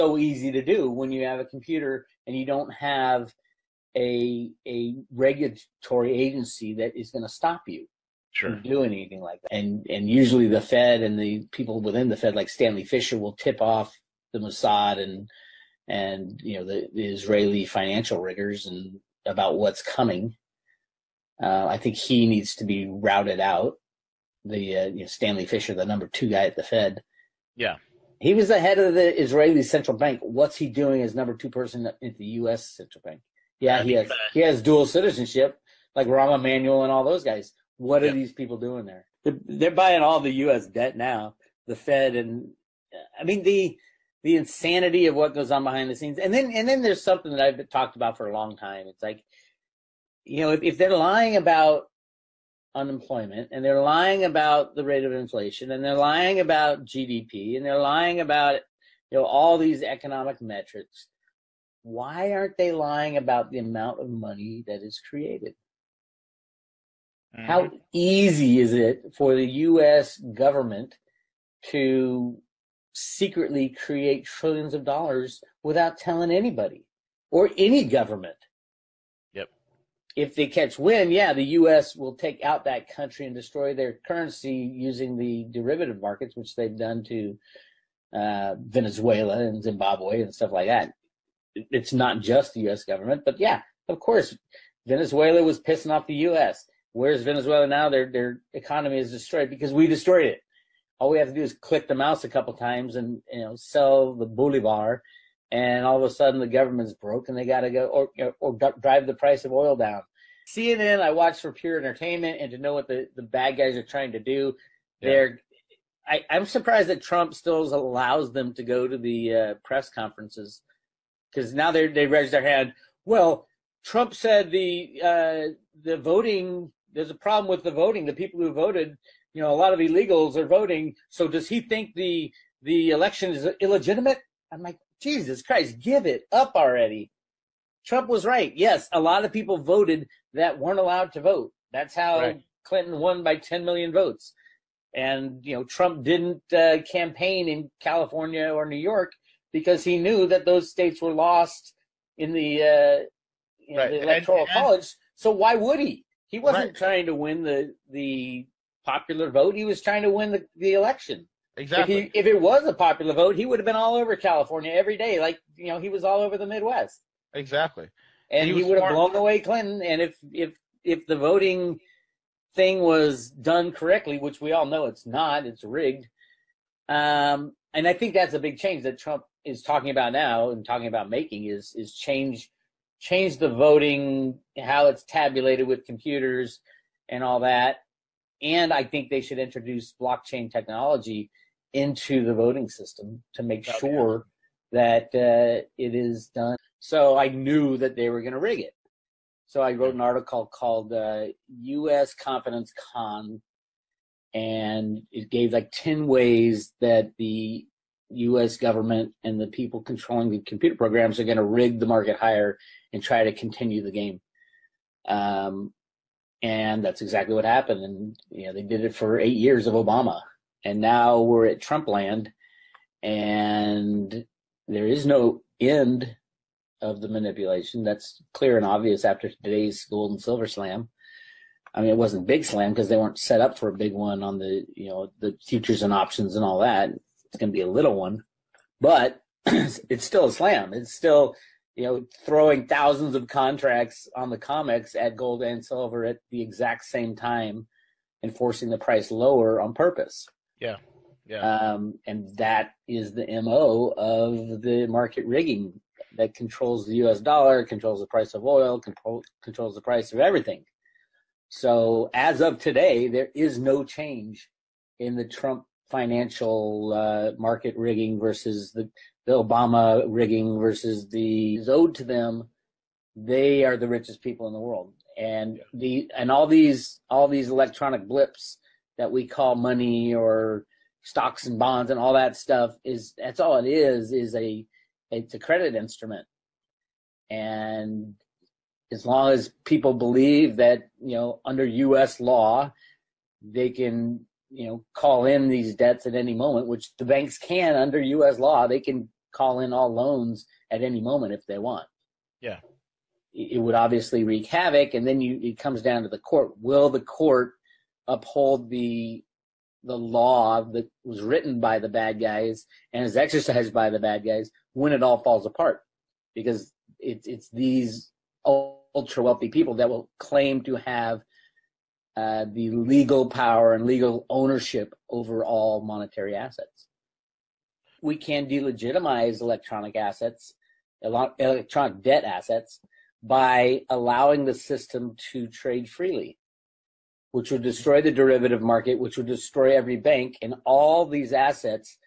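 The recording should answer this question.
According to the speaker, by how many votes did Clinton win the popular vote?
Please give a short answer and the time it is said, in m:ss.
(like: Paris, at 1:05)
10 million, at 2:23.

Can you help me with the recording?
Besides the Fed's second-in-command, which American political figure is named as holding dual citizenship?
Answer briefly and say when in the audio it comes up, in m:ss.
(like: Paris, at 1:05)
Rahm Emanuel, at 0:36.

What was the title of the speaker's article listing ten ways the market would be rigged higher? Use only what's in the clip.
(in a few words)
U.S. Confidence Con.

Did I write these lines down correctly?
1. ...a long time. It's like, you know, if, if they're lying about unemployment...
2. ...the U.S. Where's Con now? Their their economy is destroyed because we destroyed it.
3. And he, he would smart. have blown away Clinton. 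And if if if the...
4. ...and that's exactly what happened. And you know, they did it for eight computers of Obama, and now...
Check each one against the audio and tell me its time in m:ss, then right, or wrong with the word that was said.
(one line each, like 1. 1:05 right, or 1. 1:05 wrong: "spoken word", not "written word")
1. 0:48 right
2. 1:36 wrong: "Venezuela", not "Con"
3. 2:48 right
4. 3:36 wrong: "years", not "computers".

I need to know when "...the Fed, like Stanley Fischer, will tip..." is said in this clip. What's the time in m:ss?
0:12.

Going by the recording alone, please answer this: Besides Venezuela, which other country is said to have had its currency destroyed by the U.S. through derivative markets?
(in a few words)
Zimbabwe.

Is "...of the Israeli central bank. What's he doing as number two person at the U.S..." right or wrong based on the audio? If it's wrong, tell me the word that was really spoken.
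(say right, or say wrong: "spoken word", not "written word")
right.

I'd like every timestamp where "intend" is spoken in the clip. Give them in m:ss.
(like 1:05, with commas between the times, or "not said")
not said.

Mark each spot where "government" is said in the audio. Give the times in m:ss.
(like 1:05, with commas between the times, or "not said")
1:10, 1:17, 1:32, 1:46, 3:28.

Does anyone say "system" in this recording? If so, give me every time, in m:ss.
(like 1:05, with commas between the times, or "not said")
3:12, 5:34.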